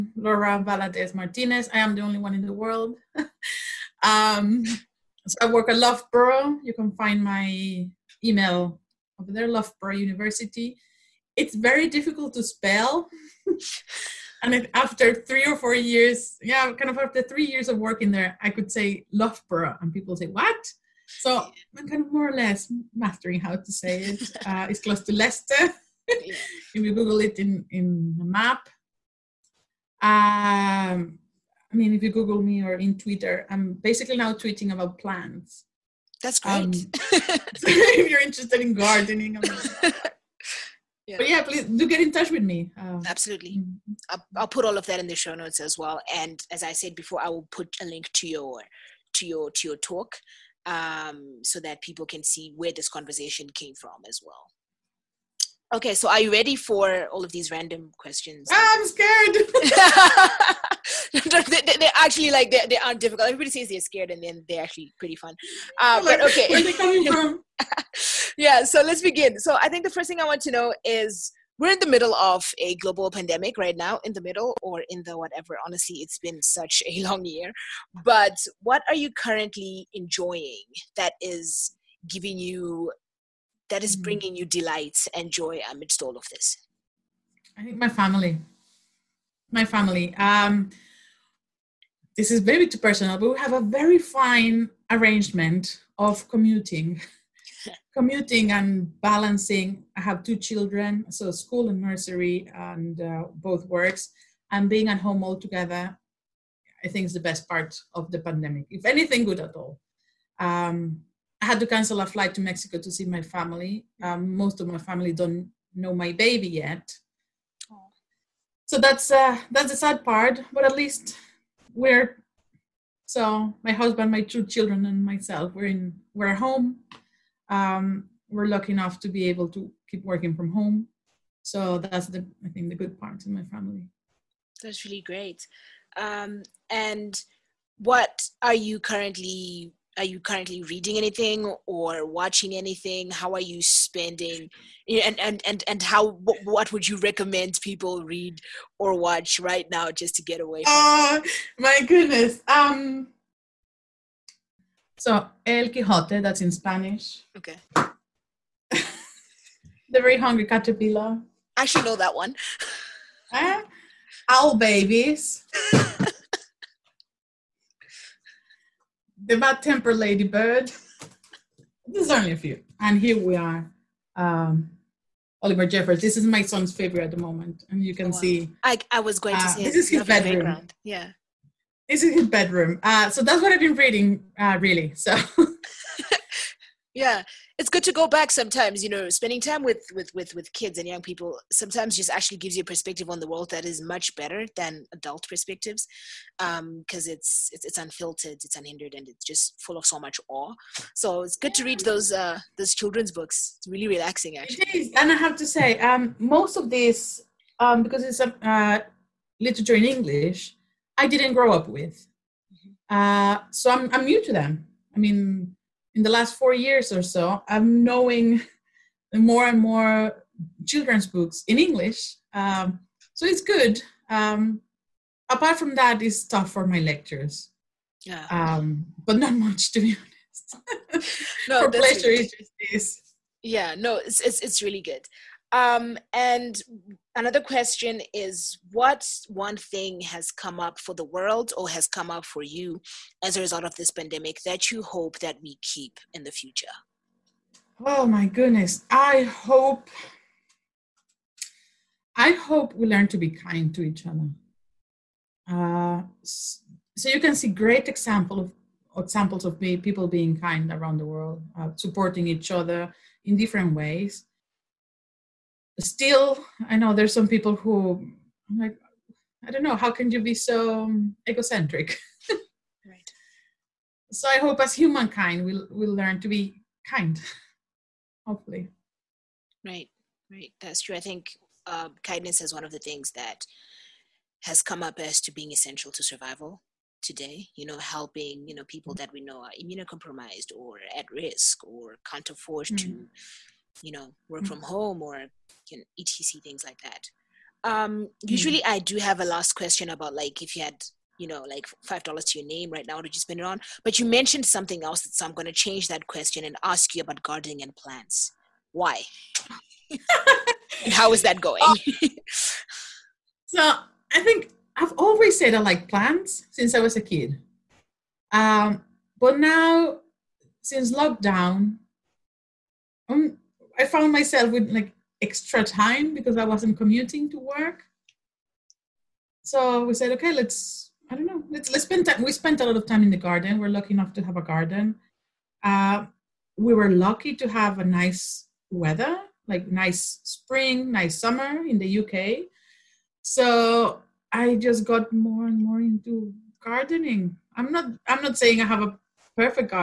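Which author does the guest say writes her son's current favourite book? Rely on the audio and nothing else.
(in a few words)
Oliver Jeffers.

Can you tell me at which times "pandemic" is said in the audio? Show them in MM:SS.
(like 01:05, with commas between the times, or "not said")
01:13, 01:48, 04:03.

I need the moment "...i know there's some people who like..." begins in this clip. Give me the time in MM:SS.
04:26.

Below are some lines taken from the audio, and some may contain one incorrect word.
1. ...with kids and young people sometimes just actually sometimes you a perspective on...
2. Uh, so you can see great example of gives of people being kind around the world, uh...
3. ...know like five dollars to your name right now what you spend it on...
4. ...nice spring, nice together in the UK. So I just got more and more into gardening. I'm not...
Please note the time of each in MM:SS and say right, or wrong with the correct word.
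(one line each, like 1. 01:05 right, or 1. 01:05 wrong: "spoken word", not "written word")
1. 03:10 wrong: "gives", not "sometimes"
2. 04:15 wrong: "examples", not "gives"
3. 05:01 right
4. 05:39 wrong: "summer", not "together".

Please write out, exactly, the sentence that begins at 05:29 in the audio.
So we said, okay, let's I don't know, let's let's spend time.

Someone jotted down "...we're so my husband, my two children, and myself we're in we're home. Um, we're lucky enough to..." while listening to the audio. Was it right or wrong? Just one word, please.
right.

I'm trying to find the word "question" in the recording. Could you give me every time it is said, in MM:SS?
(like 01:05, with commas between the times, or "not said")
00:57, 03:57, 04:59, 05:06.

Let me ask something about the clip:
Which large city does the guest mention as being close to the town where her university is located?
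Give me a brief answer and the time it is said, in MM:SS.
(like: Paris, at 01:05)
Leicester, at 00:25.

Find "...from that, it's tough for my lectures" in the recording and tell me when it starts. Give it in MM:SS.
03:45.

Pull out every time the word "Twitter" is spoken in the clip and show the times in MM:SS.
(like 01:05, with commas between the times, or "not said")
00:32.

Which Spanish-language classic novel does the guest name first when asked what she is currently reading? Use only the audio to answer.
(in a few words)
El Quijote.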